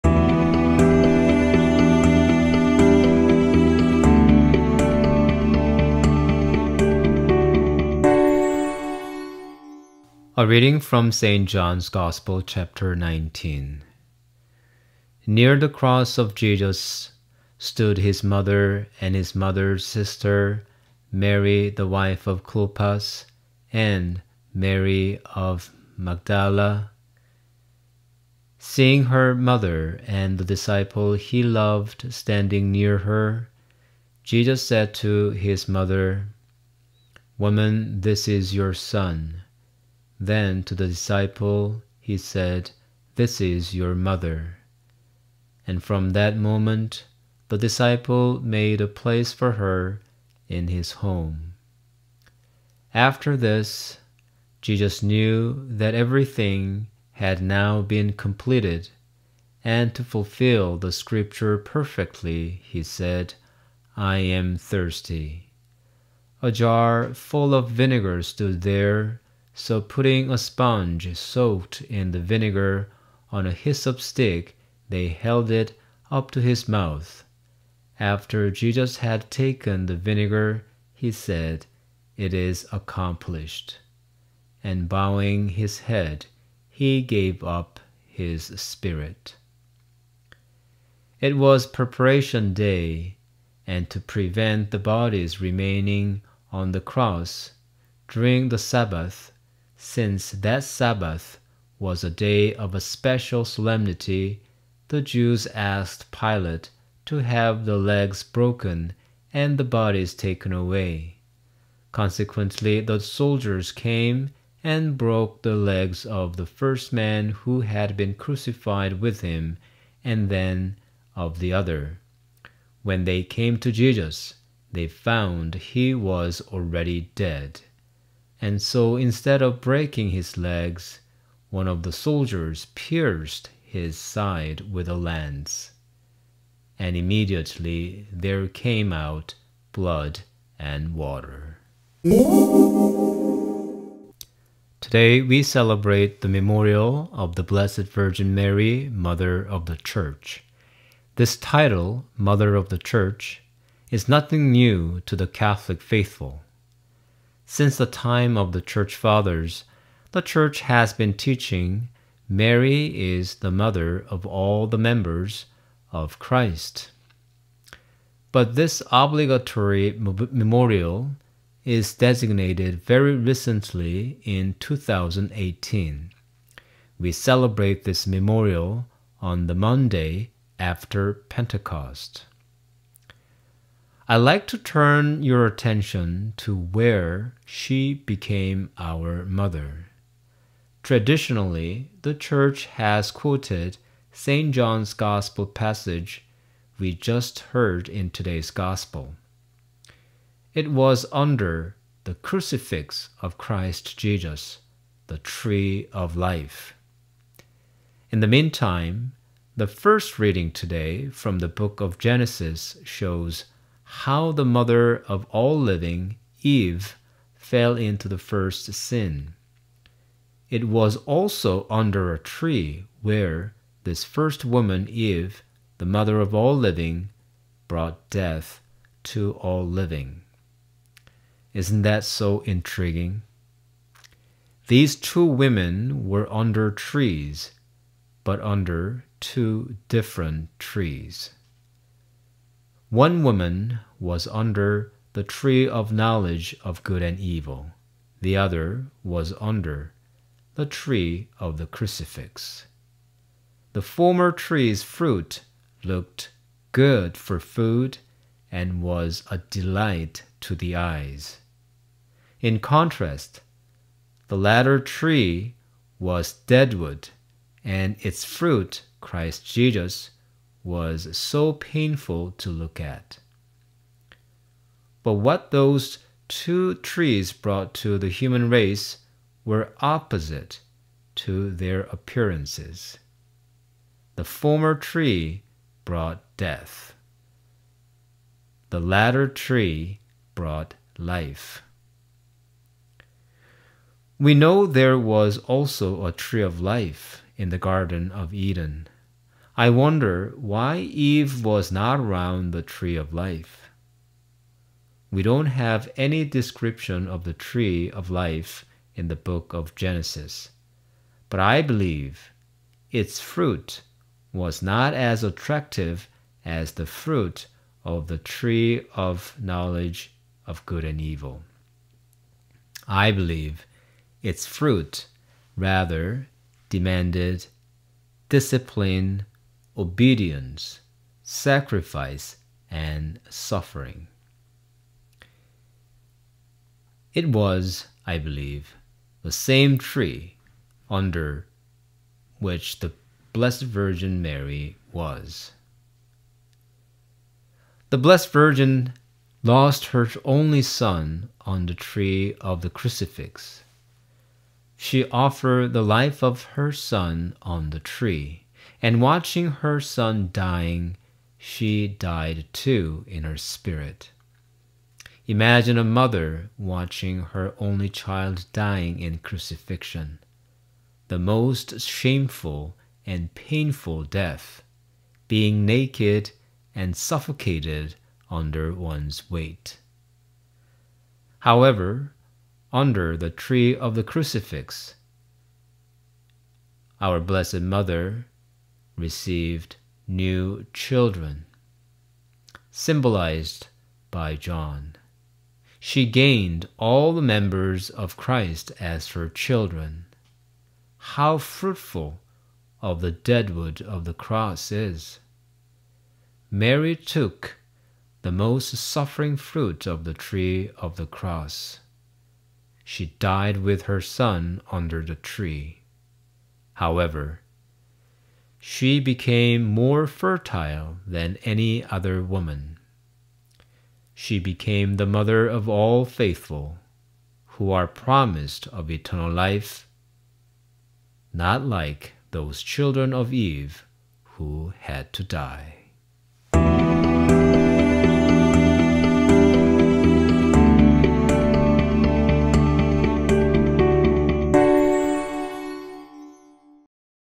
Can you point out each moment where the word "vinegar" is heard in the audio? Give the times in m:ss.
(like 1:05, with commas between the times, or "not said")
1:07, 1:12, 1:19.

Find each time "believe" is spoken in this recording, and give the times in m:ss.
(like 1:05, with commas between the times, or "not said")
5:11, 5:23, 5:38.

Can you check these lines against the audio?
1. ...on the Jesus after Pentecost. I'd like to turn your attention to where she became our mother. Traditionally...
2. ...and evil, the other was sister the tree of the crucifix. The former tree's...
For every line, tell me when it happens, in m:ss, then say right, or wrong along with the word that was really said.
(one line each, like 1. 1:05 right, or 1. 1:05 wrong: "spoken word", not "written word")
1. 2:59 wrong: "Monday", not "Jesus"
2. 4:07 wrong: "under", not "sister".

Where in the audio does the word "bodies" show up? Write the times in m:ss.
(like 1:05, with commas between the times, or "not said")
1:34, 1:49.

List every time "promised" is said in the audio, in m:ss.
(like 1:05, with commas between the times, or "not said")
7:07.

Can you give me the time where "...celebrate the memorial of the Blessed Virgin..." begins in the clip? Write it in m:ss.
2:25.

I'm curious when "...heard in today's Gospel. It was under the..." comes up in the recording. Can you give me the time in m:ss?
3:17.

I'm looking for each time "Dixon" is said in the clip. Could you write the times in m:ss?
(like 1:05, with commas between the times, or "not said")
not said.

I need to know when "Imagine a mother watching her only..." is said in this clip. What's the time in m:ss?
6:05.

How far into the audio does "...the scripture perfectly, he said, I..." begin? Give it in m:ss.
1:00.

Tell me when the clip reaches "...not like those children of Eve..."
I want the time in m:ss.
7:11.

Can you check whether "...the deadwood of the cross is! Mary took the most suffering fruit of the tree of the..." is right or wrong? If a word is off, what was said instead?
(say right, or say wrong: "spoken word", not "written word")
right.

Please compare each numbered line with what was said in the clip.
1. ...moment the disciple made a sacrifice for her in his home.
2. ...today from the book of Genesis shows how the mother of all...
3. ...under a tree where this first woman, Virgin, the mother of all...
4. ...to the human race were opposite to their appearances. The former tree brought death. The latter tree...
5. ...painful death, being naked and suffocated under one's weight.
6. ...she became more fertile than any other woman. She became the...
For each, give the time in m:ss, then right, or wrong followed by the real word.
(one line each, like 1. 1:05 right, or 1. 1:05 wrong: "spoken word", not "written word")
1. 0:46 wrong: "place", not "sacrifice"
2. 3:30 right
3. 3:41 wrong: "Eve", not "Virgin"
4. 4:37 right
5. 6:13 right
6. 6:58 right.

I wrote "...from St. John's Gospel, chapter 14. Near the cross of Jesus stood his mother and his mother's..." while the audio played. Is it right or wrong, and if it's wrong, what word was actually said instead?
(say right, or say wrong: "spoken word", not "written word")
wrong: "19", not "14".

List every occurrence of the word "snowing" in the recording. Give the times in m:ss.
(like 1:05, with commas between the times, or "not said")
not said.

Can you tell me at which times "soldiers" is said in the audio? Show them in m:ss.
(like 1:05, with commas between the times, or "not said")
1:52, 2:11.